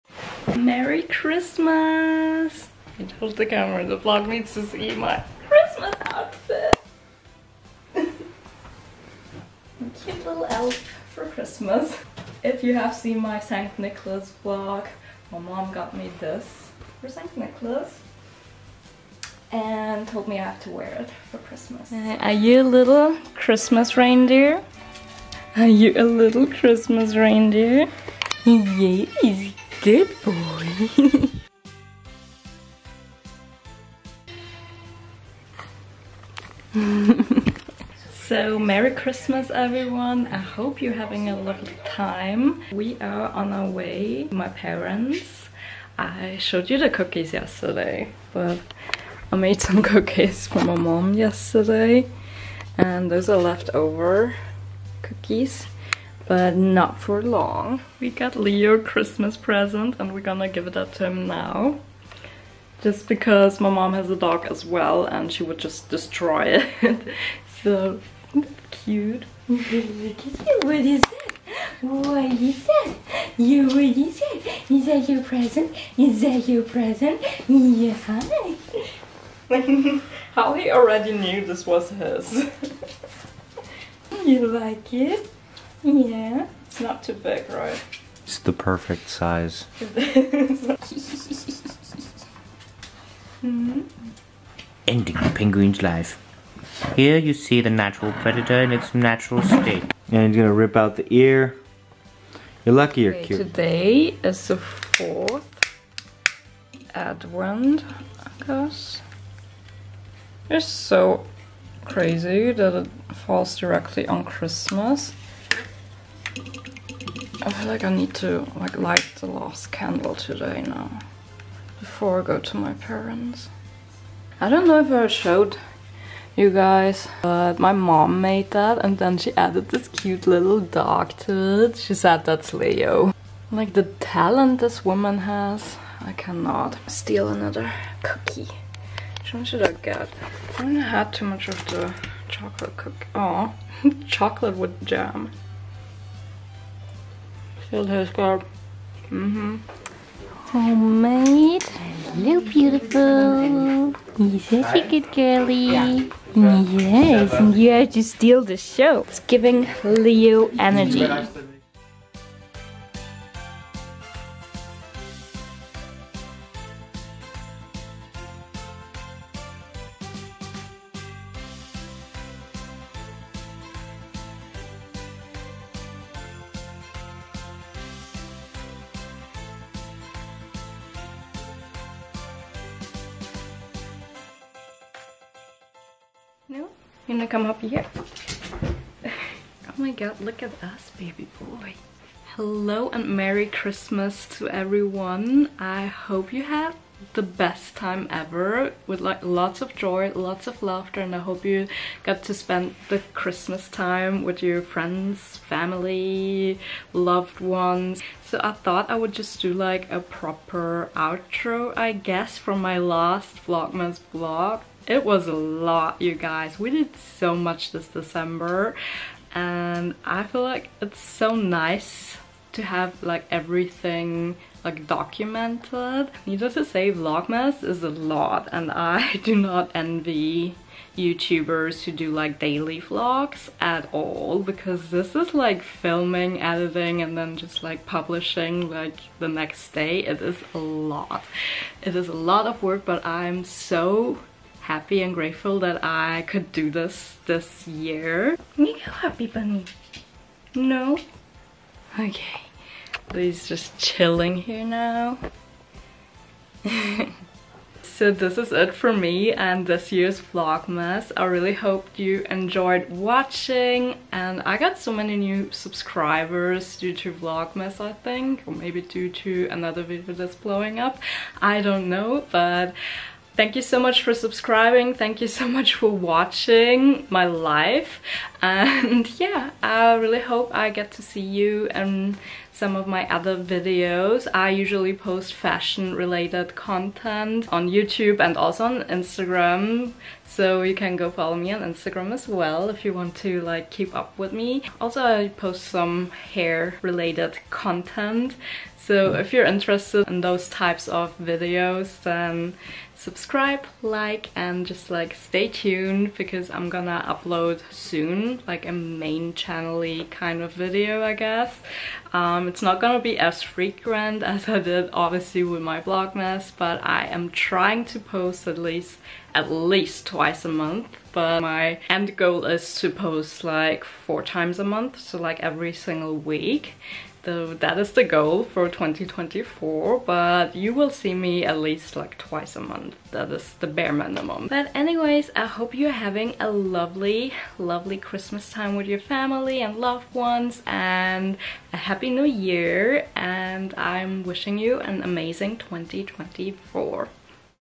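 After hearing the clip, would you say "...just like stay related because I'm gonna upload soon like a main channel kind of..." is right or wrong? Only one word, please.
wrong.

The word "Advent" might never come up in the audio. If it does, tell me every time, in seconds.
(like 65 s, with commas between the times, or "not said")
106 s.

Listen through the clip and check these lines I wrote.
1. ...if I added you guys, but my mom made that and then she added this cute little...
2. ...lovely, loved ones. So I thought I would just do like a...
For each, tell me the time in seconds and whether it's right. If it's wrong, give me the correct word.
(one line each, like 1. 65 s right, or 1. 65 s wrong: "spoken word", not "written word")
1. 124 s wrong: "showed", not "added"
2. 205 s wrong: "family", not "lovely".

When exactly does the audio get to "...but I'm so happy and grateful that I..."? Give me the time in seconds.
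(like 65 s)
242 s.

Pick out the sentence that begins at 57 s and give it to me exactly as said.
We got Leo Christmas present and we're gonna give it up to him now.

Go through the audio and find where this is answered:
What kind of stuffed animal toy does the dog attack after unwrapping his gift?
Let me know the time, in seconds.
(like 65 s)
95 s.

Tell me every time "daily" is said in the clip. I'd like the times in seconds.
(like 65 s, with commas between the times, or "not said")
232 s.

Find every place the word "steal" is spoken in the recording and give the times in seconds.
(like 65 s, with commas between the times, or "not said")
136 s, 158 s.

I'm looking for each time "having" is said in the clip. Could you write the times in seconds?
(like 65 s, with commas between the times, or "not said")
40 s, 335 s.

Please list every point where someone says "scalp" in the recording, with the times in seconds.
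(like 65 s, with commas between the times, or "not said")
148 s.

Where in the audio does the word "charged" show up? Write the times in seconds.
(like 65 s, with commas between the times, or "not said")
not said.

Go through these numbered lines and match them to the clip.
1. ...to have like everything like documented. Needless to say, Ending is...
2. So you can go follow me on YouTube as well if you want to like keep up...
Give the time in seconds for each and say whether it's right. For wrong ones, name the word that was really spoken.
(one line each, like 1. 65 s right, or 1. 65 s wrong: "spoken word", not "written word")
1. 222 s wrong: "Vlogmas", not "Ending"
2. 290 s wrong: "Instagram", not "YouTube".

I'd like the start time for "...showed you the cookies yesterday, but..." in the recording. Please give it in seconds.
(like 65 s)
46 s.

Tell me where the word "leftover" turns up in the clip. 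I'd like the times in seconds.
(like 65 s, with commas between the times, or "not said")
53 s.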